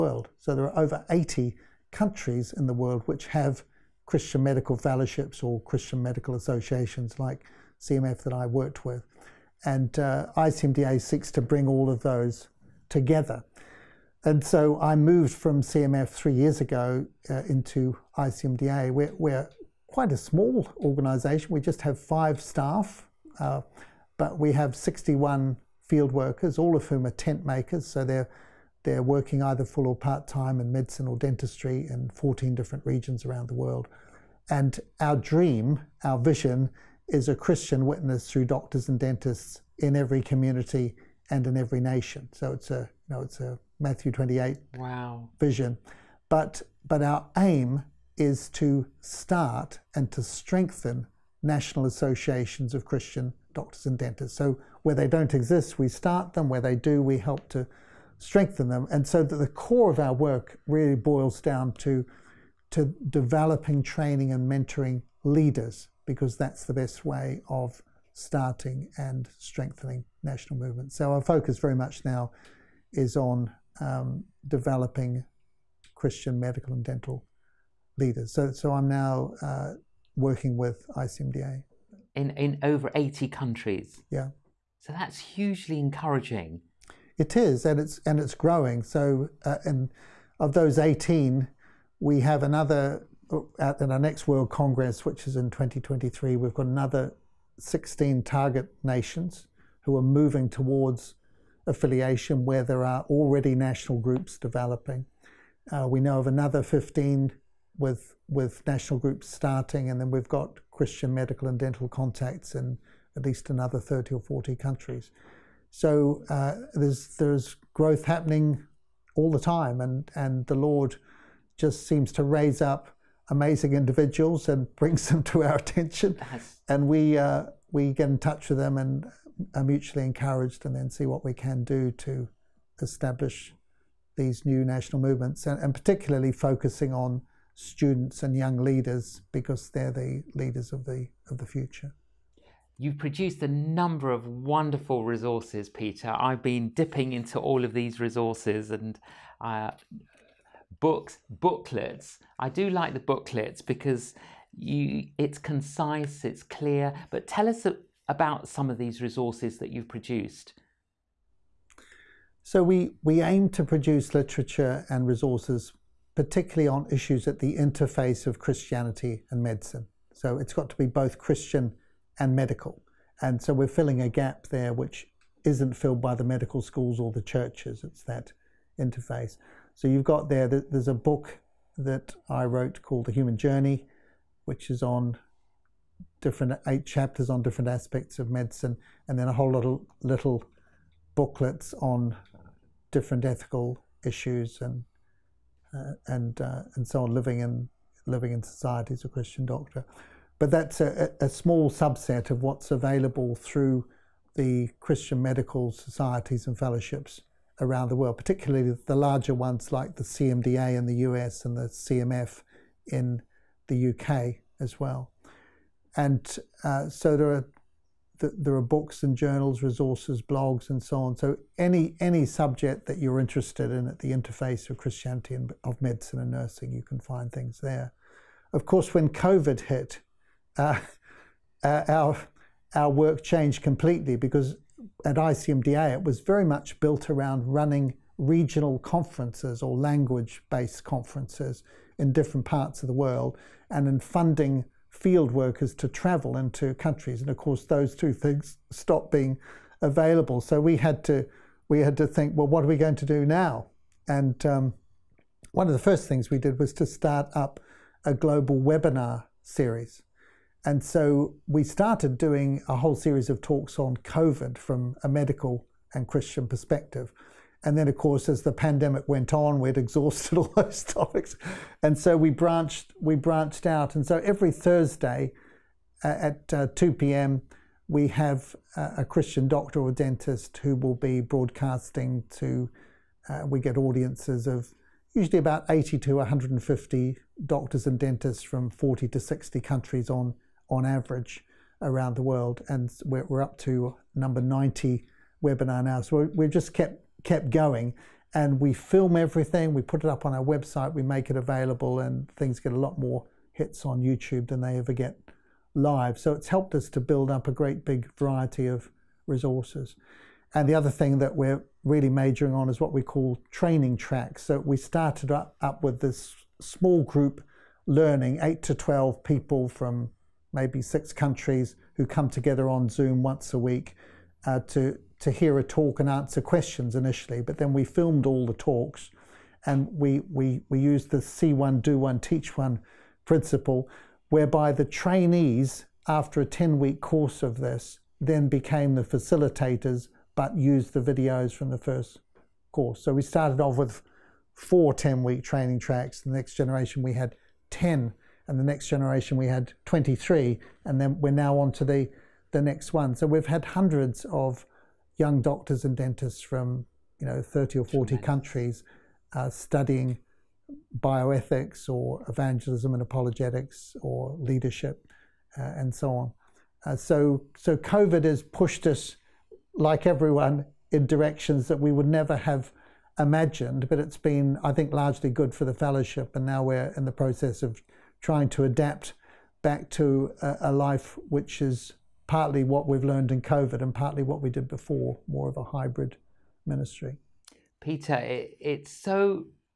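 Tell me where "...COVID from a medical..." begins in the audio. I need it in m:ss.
4:23.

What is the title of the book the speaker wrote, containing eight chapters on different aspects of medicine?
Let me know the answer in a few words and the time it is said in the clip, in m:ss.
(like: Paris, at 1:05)
The Human Journey, at 3:03.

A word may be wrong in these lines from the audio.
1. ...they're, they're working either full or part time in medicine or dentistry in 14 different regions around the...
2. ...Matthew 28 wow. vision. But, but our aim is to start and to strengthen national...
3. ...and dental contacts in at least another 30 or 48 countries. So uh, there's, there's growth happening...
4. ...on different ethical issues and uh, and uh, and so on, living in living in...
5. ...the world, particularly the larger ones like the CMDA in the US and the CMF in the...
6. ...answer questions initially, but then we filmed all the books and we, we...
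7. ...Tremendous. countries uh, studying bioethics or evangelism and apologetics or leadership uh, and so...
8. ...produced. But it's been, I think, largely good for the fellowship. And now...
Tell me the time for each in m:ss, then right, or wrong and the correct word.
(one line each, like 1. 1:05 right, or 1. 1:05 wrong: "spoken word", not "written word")
1. 0:28 right
2. 0:43 right
3. 1:51 wrong: "40", not "48"
4. 3:11 right
5. 3:27 right
6. 5:26 wrong: "talks", not "books"
7. 5:58 right
8. 6:13 wrong: "imagined", not "produced".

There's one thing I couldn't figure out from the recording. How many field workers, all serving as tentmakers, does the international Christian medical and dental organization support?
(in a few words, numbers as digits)
61.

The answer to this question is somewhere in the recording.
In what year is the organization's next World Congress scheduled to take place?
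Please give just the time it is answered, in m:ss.
1:35.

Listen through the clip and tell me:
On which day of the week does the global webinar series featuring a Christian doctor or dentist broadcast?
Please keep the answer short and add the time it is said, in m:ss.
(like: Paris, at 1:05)
Thursday, at 4:34.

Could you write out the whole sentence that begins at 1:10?
So our focus very much now is on um, developing Christian medical and dental leaders.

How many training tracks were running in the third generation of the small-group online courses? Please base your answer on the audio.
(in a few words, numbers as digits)
23.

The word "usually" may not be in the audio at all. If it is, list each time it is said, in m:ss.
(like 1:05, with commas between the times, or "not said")
4:45.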